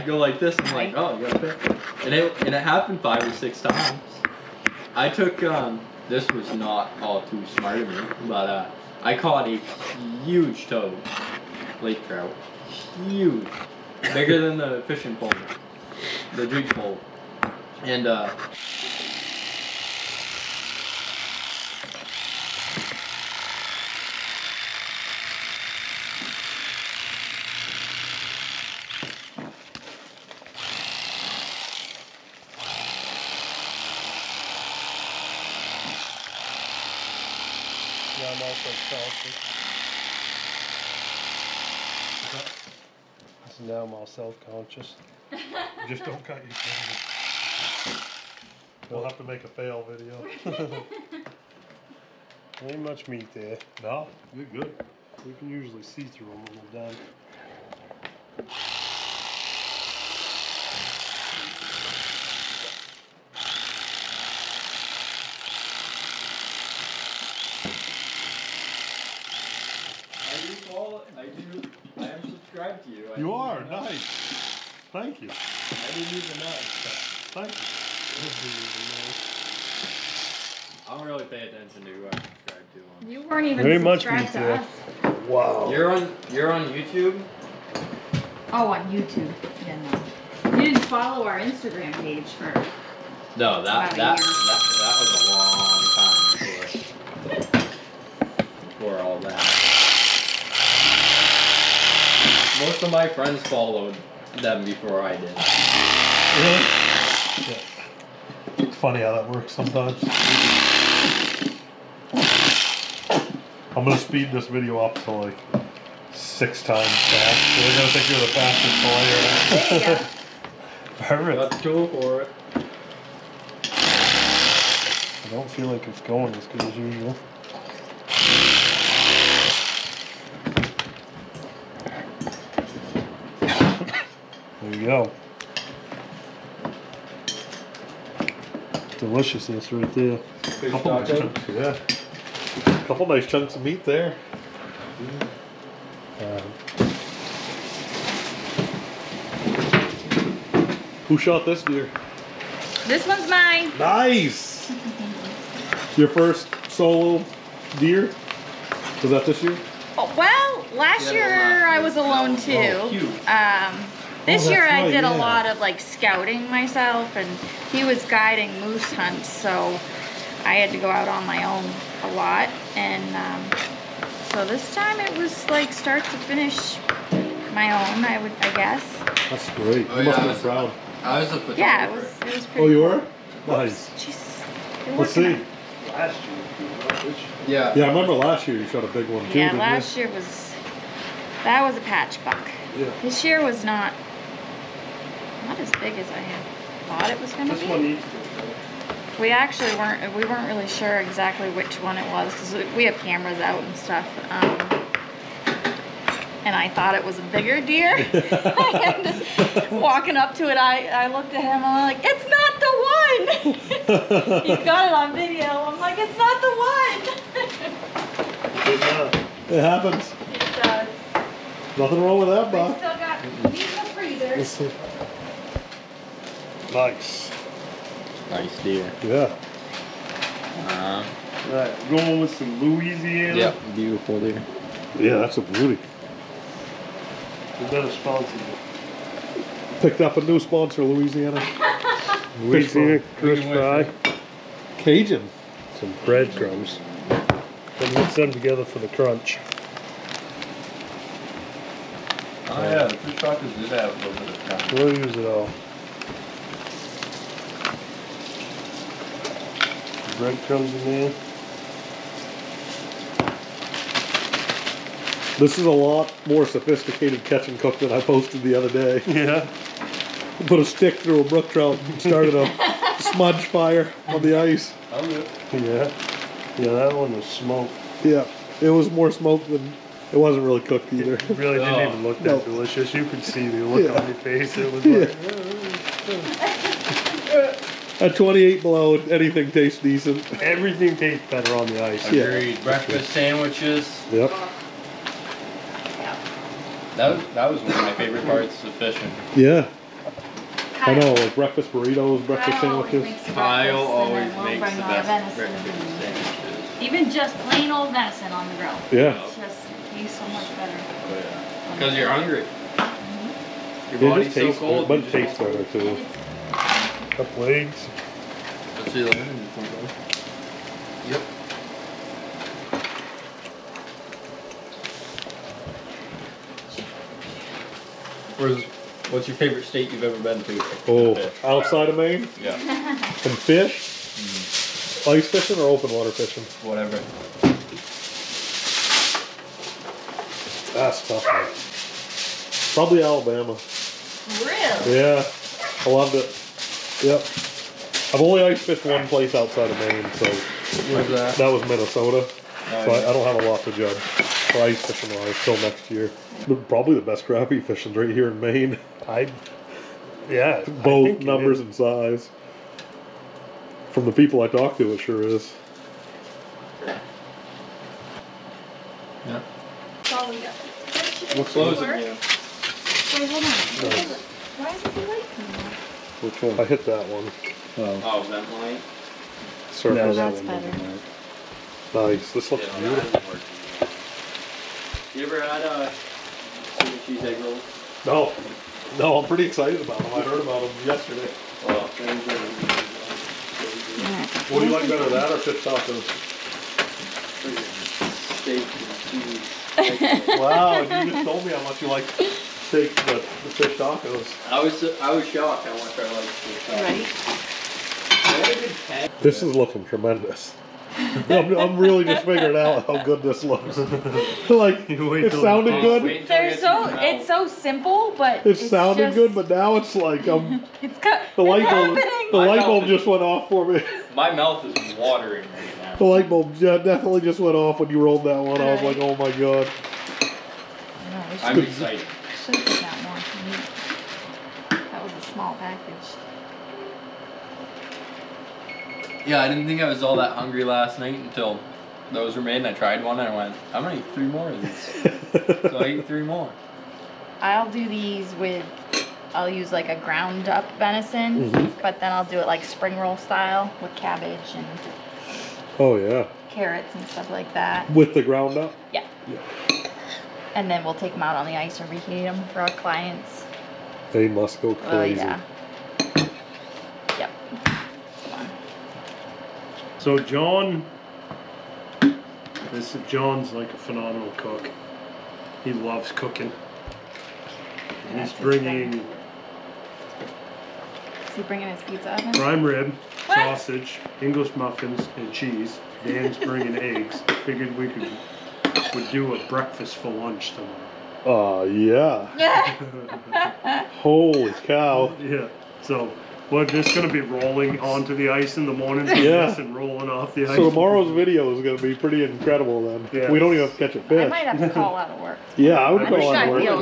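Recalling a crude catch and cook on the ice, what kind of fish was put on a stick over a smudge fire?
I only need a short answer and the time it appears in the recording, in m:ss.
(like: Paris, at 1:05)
brook trout, at 4:31.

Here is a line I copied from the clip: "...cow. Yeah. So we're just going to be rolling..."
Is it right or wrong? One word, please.
right.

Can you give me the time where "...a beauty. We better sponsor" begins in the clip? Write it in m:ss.
3:55.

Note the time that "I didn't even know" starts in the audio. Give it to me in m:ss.
1:15.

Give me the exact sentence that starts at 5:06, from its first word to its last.
Even just plain old venison on the grill.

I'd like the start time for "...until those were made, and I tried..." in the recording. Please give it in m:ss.
7:21.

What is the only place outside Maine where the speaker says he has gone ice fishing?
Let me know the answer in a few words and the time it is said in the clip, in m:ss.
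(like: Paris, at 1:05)
Minnesota, at 5:51.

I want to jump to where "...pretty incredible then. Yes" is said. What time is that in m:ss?
8:21.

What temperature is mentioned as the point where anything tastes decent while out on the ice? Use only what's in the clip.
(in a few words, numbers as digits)
28 below.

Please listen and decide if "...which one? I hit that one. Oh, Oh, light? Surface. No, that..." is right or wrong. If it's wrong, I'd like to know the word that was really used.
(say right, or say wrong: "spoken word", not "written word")
right.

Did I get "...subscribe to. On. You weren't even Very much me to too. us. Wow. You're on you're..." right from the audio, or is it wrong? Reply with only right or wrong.
right.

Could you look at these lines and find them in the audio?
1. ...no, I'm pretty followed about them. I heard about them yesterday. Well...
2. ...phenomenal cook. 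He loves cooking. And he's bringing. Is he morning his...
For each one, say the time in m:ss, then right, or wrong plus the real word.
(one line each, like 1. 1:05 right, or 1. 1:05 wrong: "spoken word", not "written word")
1. 6:28 wrong: "excited", not "followed"
2. 7:53 wrong: "bringing", not "morning".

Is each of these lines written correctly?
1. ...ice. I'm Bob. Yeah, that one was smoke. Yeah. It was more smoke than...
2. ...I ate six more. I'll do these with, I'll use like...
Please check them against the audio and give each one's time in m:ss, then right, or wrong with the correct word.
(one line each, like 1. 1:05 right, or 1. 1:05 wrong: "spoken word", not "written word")
1. 4:34 wrong: "Yeah", not "Bob"
2. 7:25 wrong: "three", not "six".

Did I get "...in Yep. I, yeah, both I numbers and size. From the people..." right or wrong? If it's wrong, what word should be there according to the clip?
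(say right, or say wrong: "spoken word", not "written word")
wrong: "Maine", not "Yep".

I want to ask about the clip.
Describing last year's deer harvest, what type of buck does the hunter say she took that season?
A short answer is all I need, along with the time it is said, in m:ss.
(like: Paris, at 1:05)
patch buck, at 3:11.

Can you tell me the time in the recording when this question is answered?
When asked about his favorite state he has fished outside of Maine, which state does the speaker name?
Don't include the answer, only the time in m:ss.
5:43.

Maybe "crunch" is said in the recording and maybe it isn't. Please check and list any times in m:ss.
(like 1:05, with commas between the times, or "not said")
4:08.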